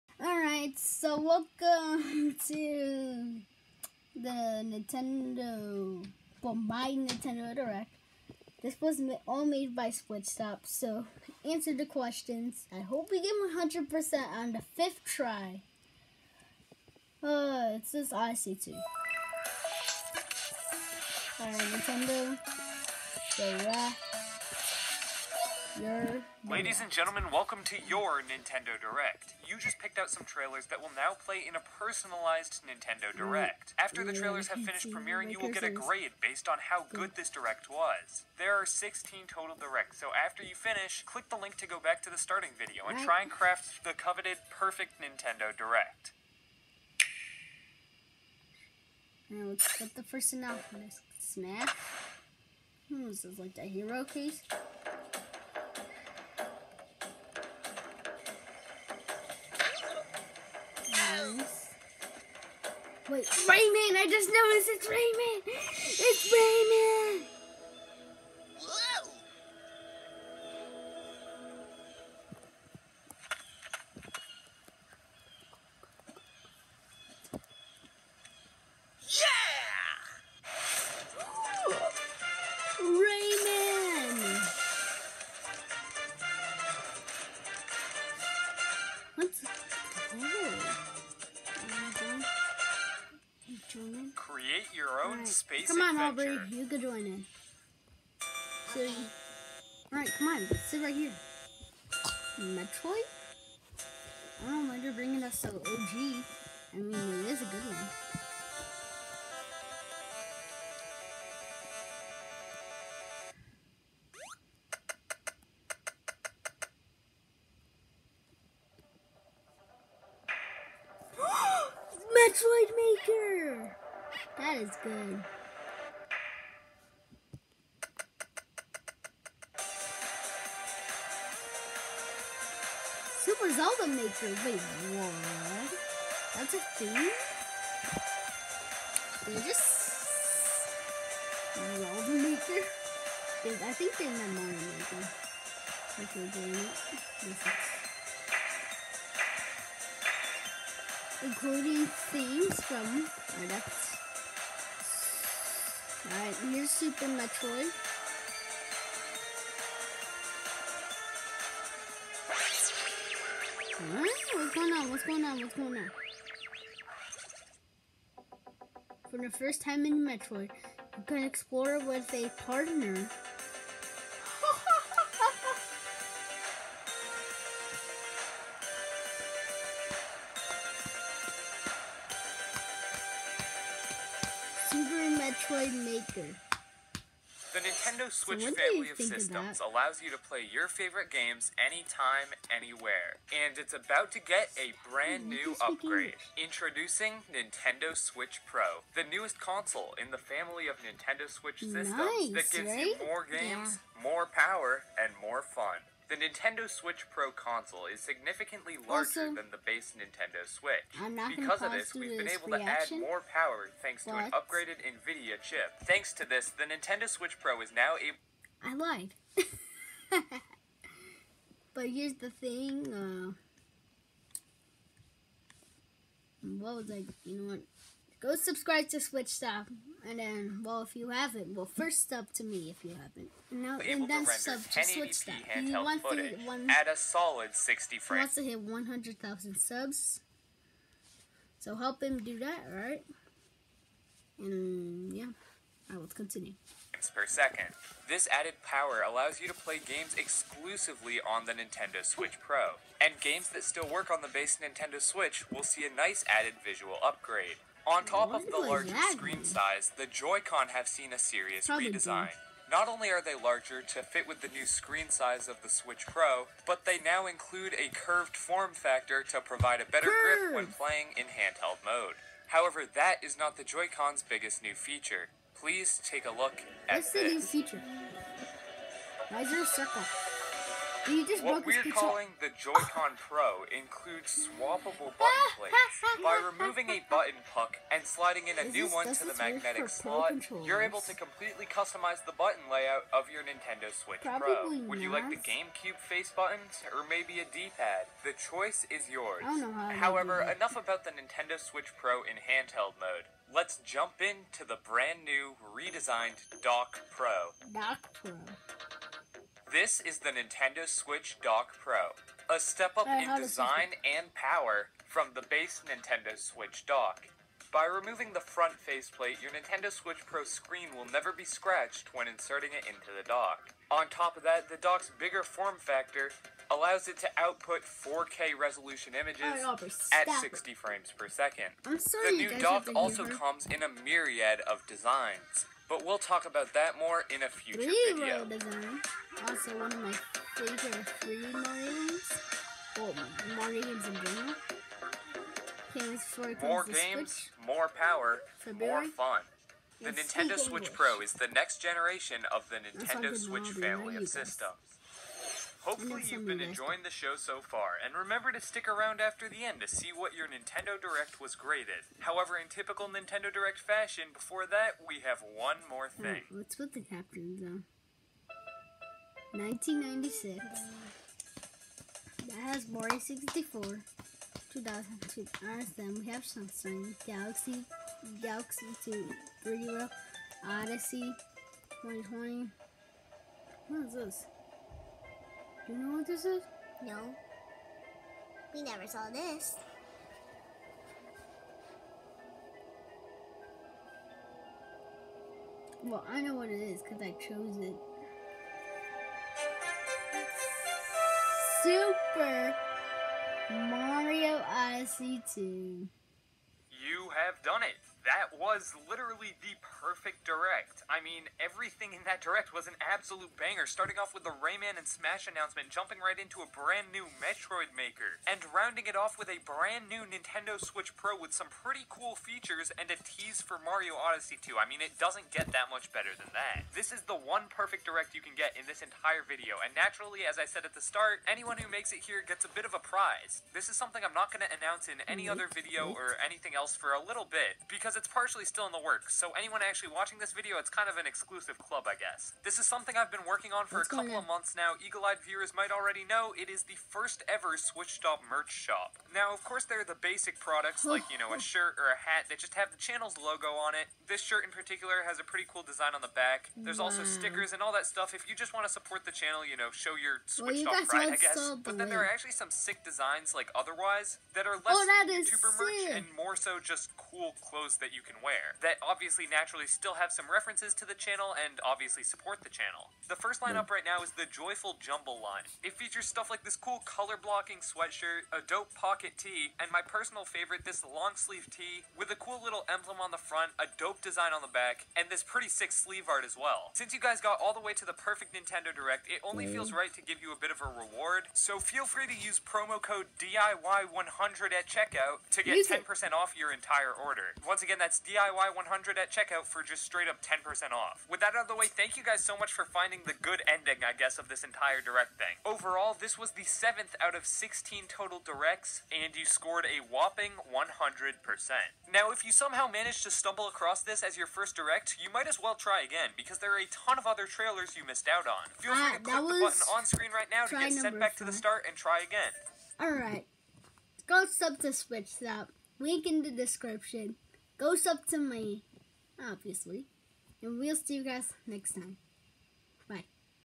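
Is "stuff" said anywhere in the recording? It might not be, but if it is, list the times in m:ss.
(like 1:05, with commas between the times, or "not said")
7:38, 7:56.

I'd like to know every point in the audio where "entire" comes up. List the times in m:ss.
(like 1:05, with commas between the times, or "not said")
7:09, 8:16, 8:24.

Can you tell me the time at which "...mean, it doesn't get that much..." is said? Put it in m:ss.
7:04.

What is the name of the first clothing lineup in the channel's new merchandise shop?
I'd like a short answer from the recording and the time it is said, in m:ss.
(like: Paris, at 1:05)
Joyful Jumble, at 7:54.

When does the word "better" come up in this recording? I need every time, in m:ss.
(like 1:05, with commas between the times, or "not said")
4:29, 7:06.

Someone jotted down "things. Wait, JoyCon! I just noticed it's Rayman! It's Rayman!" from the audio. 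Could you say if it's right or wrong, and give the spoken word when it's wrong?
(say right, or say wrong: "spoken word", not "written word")
wrong: "Rayman", not "JoyCon".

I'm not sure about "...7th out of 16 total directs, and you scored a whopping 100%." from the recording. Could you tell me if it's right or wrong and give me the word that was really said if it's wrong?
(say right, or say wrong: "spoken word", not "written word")
right.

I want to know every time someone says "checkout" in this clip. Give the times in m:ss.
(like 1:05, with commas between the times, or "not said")
8:14, 8:19.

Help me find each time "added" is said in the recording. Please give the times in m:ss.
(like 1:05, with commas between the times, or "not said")
4:08, 4:16.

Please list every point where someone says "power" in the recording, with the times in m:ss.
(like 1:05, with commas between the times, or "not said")
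3:24, 3:33, 4:08, 5:14, 5:47.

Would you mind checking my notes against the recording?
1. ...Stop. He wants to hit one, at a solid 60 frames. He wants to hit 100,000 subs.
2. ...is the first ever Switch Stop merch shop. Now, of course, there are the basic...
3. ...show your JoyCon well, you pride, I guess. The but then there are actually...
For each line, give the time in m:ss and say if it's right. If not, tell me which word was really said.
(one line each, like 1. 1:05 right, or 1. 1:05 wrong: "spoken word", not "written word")
1. 3:55 right
2. 7:26 right
3. 7:39 wrong: "Switched", not "JoyCon".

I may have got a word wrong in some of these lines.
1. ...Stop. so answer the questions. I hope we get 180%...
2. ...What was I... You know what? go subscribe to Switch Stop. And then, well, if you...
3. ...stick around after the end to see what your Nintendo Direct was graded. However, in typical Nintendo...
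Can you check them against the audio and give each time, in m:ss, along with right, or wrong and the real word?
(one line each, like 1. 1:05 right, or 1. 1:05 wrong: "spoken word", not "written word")
1. 0:09 wrong: "100", not "180"
2. 3:46 right
3. 5:58 right.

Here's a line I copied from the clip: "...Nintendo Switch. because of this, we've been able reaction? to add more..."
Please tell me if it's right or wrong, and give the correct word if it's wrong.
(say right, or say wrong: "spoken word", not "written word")
right.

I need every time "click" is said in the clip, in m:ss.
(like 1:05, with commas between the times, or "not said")
0:41, 8:39.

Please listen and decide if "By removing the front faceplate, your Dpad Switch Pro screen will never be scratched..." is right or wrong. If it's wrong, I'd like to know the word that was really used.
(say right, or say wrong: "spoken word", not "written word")
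wrong: "Nintendo", not "Dpad".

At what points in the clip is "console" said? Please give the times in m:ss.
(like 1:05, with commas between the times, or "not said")
3:19, 3:27.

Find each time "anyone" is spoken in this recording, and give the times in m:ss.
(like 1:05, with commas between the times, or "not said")
7:11, 7:19.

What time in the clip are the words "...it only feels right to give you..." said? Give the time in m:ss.
8:09.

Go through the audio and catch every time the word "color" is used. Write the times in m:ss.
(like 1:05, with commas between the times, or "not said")
7:57.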